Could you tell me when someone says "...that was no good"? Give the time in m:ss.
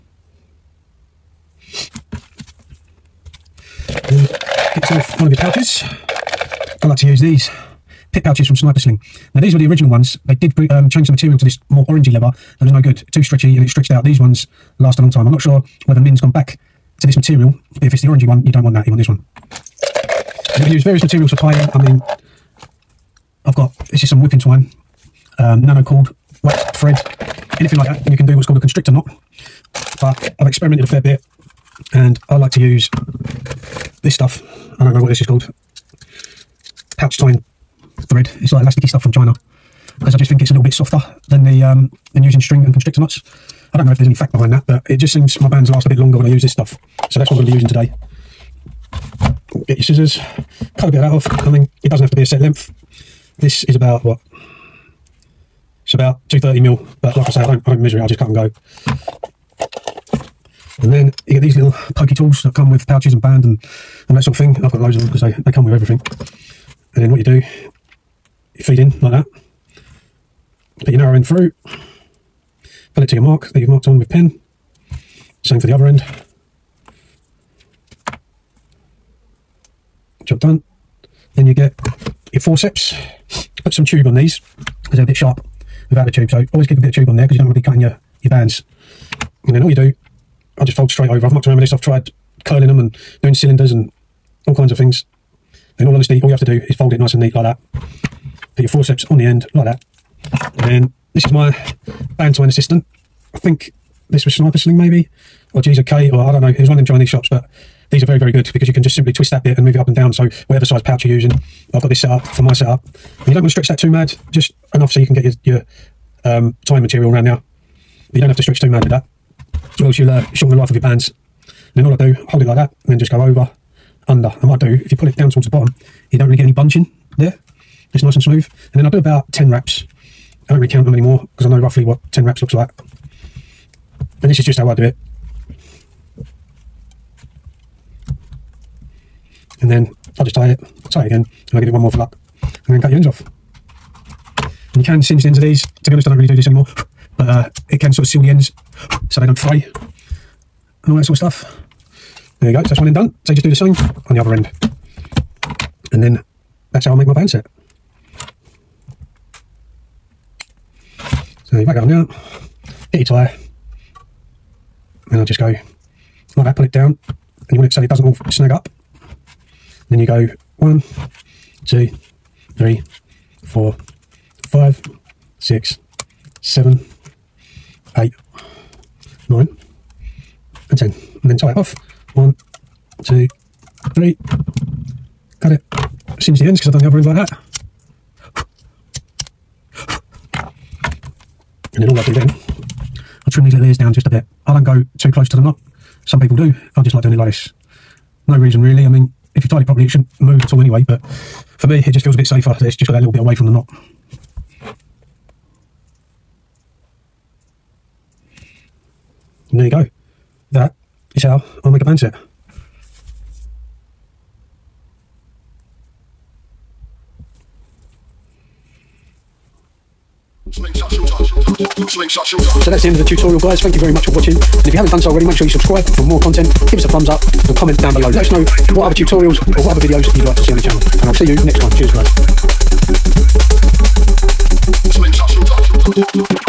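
0:12.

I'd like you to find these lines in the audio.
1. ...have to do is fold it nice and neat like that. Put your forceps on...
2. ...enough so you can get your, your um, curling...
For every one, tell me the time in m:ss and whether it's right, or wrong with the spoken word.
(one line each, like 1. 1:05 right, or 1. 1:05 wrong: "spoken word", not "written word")
1. 1:36 right
2. 1:54 wrong: "tying", not "curling".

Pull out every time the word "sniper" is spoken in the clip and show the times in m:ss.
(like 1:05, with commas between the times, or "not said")
0:08, 1:44.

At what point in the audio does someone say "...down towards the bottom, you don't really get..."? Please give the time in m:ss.
2:05.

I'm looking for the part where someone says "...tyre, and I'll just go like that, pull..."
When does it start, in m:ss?
2:43.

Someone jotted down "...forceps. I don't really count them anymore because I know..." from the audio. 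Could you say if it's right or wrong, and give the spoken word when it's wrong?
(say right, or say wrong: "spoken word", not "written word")
wrong: "wraps", not "forceps".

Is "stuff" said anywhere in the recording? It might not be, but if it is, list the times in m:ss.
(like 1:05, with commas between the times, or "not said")
0:34, 0:38, 0:46, 2:31.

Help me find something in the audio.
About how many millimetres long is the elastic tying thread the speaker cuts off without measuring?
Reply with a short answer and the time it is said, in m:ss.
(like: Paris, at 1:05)
230, at 0:56.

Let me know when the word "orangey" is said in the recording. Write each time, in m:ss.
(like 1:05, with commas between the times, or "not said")
0:11, 0:18.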